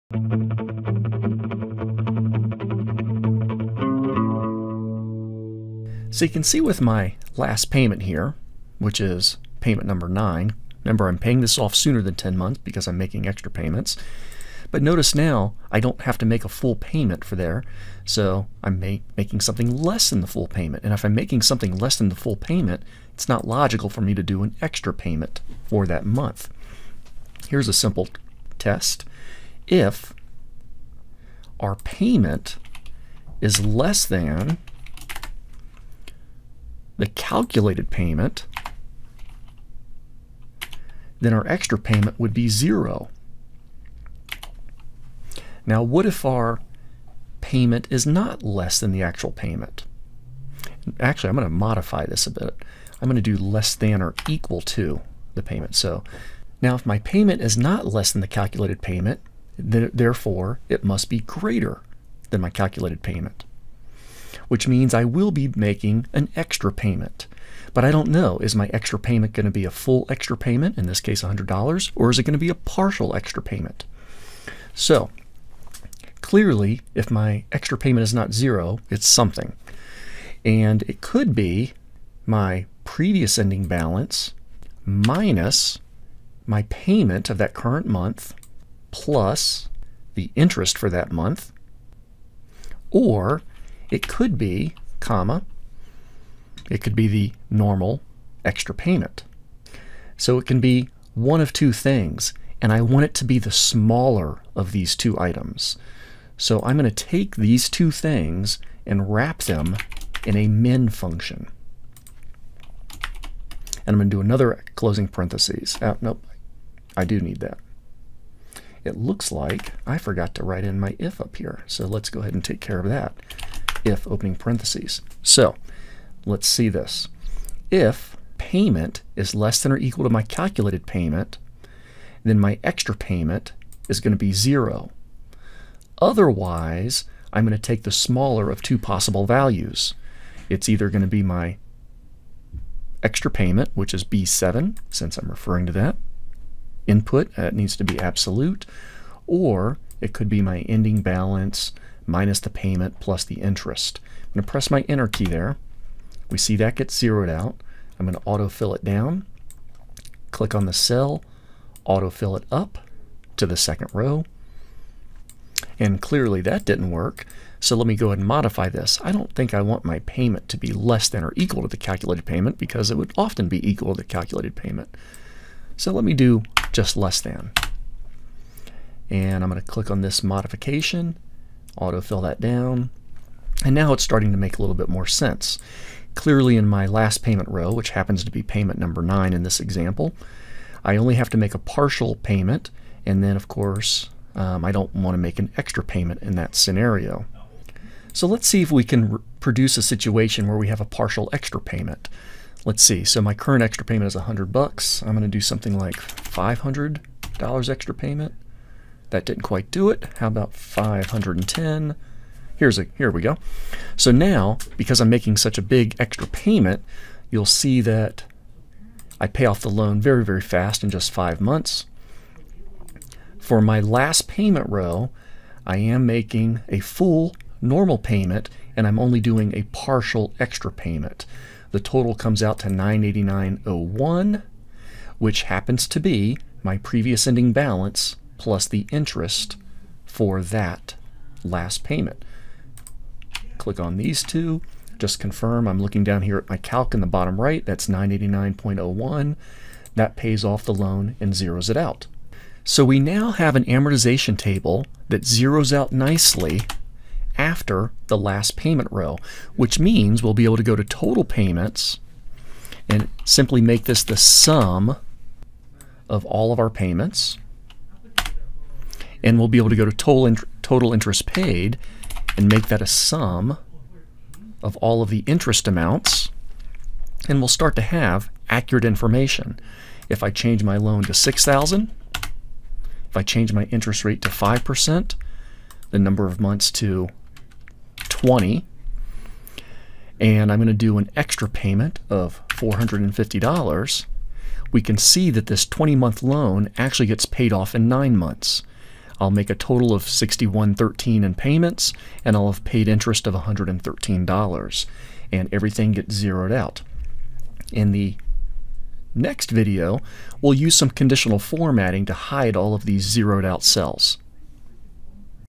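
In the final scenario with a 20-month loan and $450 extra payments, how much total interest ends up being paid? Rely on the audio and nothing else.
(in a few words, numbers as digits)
$113.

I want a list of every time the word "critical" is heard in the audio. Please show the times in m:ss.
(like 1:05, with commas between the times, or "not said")
not said.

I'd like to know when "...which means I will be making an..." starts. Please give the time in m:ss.
1:04.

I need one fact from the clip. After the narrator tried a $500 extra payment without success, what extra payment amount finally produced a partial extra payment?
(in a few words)
$510.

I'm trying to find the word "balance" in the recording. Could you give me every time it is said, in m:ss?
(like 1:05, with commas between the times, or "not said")
1:23, 2:31, 3:57.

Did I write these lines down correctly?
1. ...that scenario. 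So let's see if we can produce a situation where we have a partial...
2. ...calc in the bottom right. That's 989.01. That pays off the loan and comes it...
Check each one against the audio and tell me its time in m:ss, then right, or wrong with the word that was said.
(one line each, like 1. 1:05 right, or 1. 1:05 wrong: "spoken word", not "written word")
1. 3:16 right
2. 4:06 wrong: "zeroes", not "comes".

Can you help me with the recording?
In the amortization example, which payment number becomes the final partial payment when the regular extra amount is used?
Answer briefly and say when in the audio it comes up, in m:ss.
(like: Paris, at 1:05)
9, at 0:09.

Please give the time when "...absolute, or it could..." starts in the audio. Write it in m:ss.
2:27.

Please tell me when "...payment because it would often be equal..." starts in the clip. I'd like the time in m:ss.
2:52.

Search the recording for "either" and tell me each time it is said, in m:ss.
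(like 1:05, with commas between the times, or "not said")
2:20.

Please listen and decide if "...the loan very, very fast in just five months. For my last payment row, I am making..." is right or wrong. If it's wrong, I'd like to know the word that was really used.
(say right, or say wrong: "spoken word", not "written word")
right.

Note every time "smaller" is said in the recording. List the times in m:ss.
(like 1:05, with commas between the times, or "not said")
1:43, 2:17.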